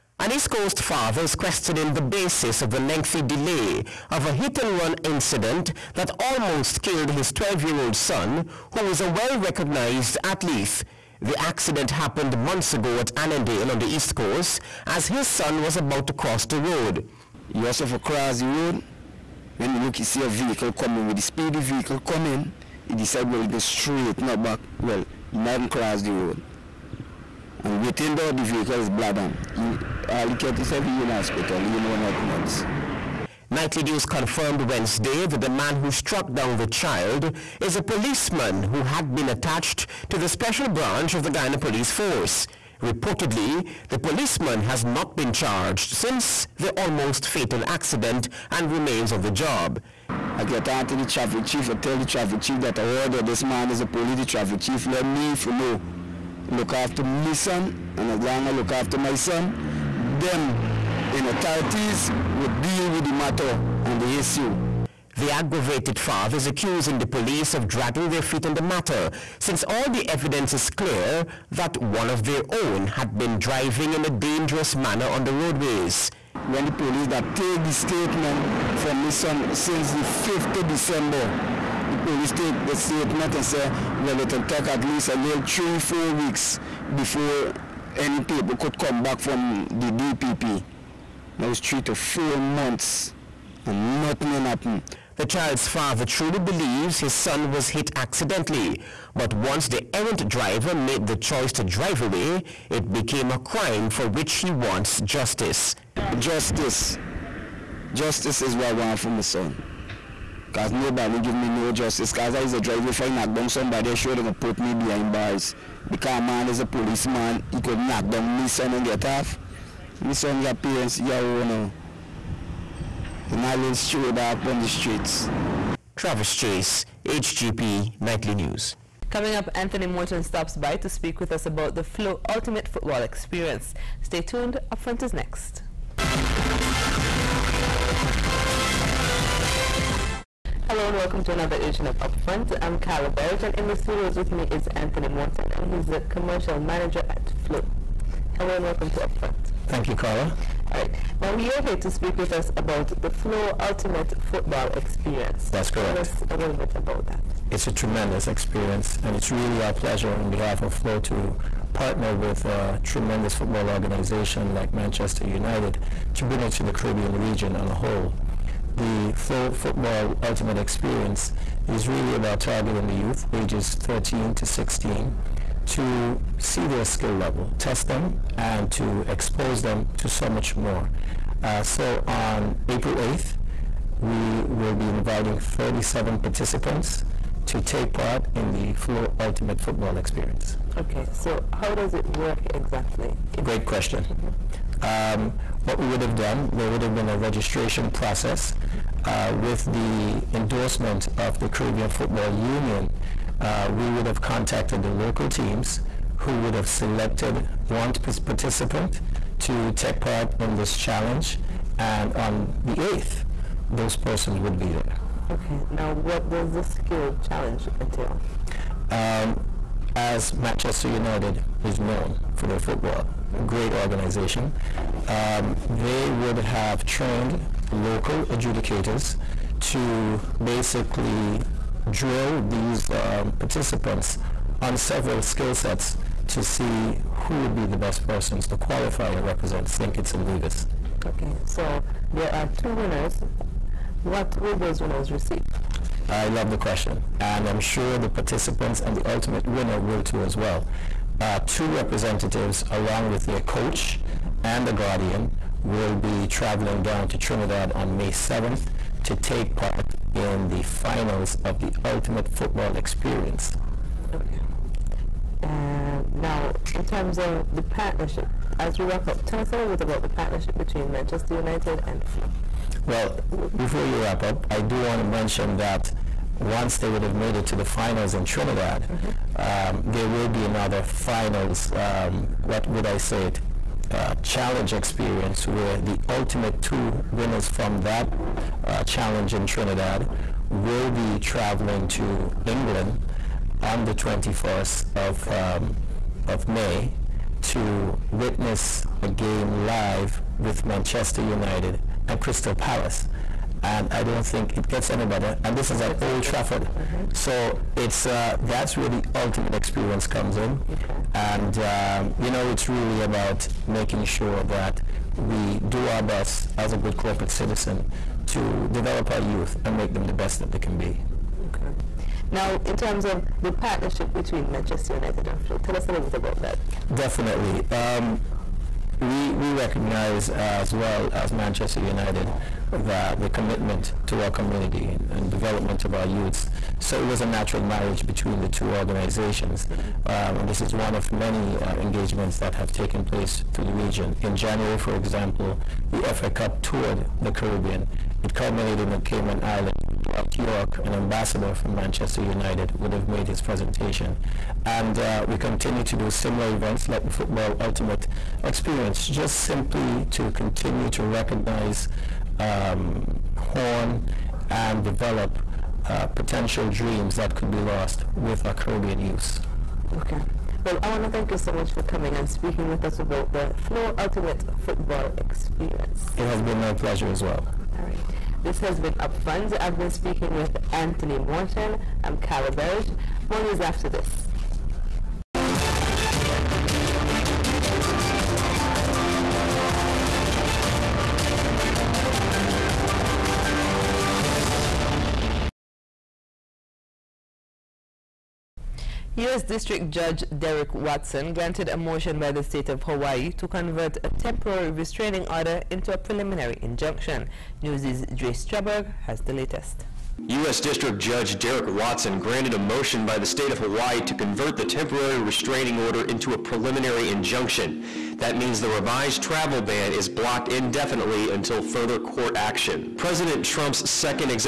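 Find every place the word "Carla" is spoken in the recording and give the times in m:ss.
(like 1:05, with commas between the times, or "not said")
2:22, 2:29, 6:22.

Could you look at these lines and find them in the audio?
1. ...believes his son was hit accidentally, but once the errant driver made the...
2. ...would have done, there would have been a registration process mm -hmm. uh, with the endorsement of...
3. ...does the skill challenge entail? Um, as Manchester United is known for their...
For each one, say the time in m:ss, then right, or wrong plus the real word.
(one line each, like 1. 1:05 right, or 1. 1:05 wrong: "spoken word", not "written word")
1. 1:36 right
2. 3:15 right
3. 3:36 right.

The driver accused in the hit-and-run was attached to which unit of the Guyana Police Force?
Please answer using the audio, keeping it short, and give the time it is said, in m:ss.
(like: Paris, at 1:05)
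special branch, at 0:40.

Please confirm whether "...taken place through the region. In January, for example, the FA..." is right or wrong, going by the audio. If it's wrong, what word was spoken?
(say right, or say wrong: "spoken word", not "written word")
right.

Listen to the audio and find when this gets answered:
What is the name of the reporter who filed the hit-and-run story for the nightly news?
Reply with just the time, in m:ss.
2:05.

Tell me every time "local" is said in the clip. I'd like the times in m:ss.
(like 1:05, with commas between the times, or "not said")
3:24, 3:47.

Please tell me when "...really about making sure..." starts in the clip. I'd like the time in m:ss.
5:12.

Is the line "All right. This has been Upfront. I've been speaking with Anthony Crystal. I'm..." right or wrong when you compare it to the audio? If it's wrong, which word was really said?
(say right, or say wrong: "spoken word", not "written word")
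wrong: "Morton", not "Crystal".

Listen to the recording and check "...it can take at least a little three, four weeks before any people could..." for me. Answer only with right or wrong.
right.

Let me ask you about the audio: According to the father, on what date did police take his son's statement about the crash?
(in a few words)
5th December.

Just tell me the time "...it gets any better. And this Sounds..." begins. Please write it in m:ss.
5:04.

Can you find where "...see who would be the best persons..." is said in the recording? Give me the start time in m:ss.
3:56.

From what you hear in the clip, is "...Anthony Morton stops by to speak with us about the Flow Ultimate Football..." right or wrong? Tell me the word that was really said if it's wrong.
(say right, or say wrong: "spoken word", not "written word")
right.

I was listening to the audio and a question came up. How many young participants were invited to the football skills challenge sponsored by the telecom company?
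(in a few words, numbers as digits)
37.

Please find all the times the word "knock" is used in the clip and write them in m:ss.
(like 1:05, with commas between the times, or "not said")
1:53, 1:57.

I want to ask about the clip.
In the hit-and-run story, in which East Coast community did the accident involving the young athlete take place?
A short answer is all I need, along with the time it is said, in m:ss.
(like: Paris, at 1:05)
Annandale, at 0:13.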